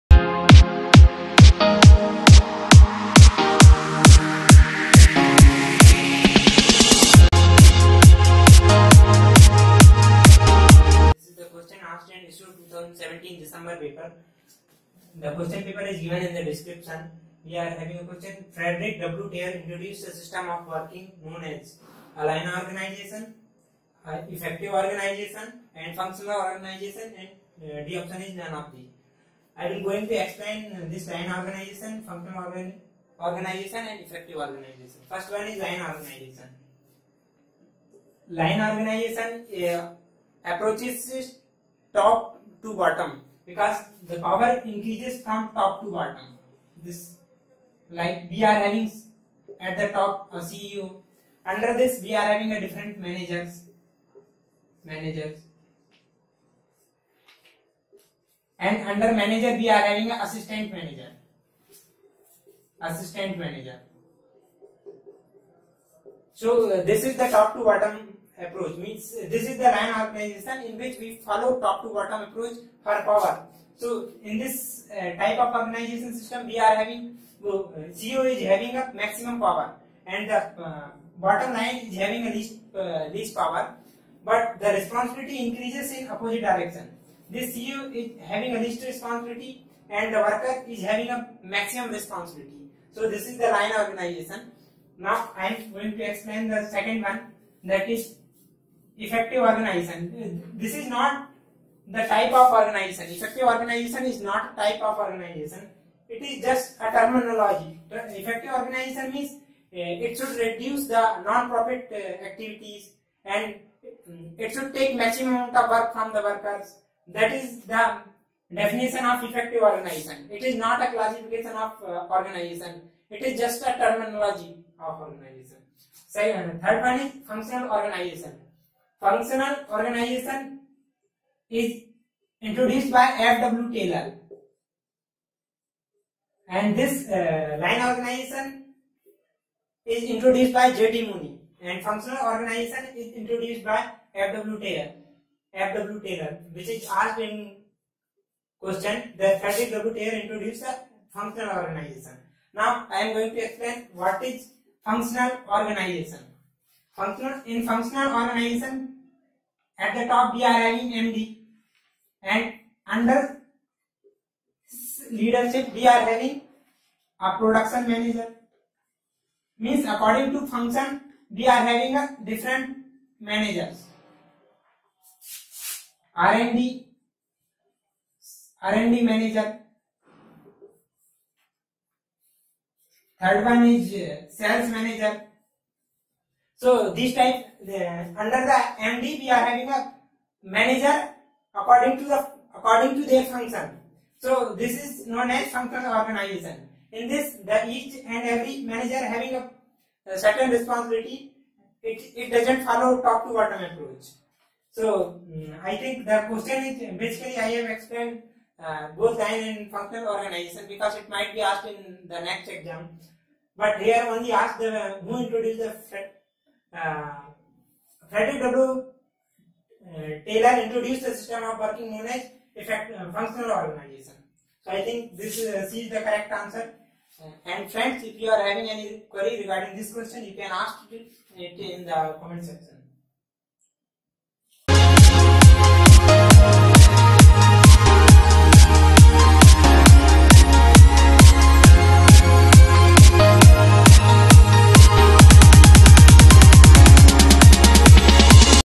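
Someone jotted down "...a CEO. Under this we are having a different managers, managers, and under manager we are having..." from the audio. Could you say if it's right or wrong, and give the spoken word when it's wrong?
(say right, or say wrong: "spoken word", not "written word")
right.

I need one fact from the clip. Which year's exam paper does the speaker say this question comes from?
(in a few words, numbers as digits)
2017.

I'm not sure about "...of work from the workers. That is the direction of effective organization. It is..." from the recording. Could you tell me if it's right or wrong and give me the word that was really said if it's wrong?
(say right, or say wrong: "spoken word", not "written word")
wrong: "definition", not "direction".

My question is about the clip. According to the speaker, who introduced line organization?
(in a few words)
J.T. Mooney.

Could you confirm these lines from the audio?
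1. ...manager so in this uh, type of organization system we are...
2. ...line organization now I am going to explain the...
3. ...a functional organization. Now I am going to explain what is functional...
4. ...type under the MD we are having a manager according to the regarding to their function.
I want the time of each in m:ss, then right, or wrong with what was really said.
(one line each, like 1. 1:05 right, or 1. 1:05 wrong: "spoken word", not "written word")
1. 1:13 wrong: "power", not "manager"
2. 1:33 right
3. 2:30 right
4. 3:07 wrong: "according", not "regarding".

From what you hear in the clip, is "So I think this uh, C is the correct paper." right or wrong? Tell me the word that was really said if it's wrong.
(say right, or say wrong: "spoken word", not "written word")
wrong: "answer", not "paper".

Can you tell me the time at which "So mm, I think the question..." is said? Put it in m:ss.
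3:24.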